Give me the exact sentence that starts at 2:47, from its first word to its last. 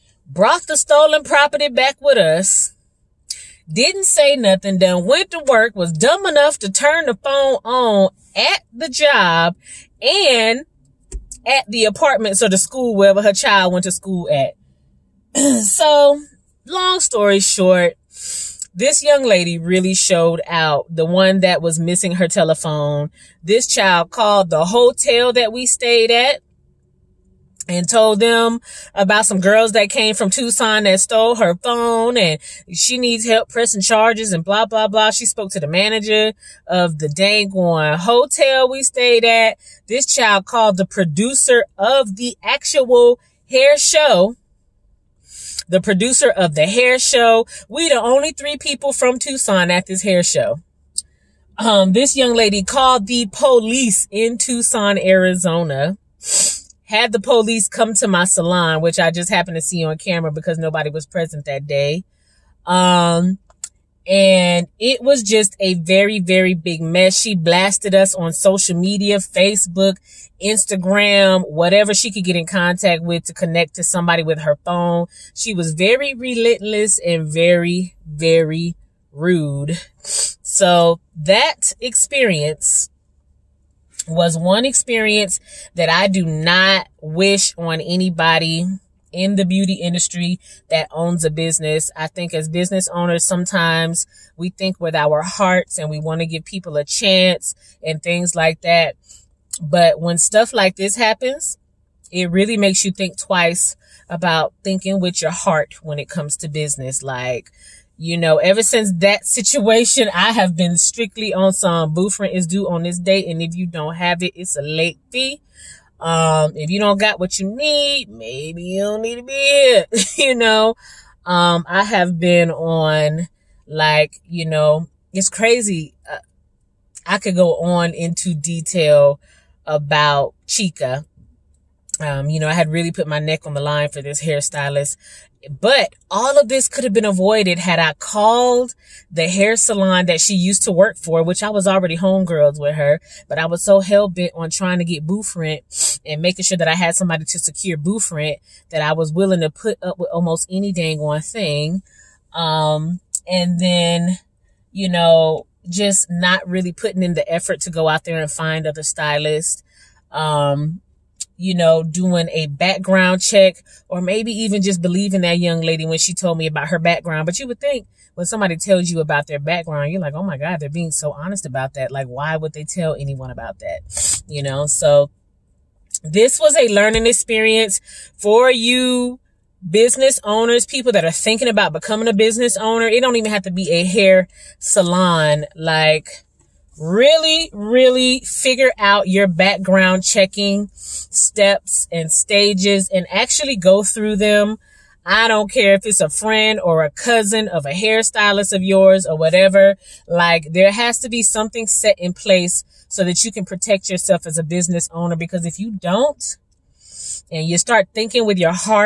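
But you would think when somebody tells you about their background, you're like, oh my God, they're being so honest about that.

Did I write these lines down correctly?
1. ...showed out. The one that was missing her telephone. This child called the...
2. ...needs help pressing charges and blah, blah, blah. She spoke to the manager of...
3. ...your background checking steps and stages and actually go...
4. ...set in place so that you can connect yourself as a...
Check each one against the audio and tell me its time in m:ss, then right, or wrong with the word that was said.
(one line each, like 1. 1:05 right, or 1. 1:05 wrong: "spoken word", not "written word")
1. 0:19 right
2. 0:32 right
3. 3:09 right
4. 3:21 wrong: "protect", not "connect".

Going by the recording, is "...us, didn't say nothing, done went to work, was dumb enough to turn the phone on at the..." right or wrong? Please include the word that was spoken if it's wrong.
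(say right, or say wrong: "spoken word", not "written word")
right.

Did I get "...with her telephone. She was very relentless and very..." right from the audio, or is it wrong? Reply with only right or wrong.
wrong.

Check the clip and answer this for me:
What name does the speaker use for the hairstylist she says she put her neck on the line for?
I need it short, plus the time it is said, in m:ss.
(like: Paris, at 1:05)
Chica, at 2:10.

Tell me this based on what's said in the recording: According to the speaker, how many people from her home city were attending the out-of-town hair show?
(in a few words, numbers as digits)
3.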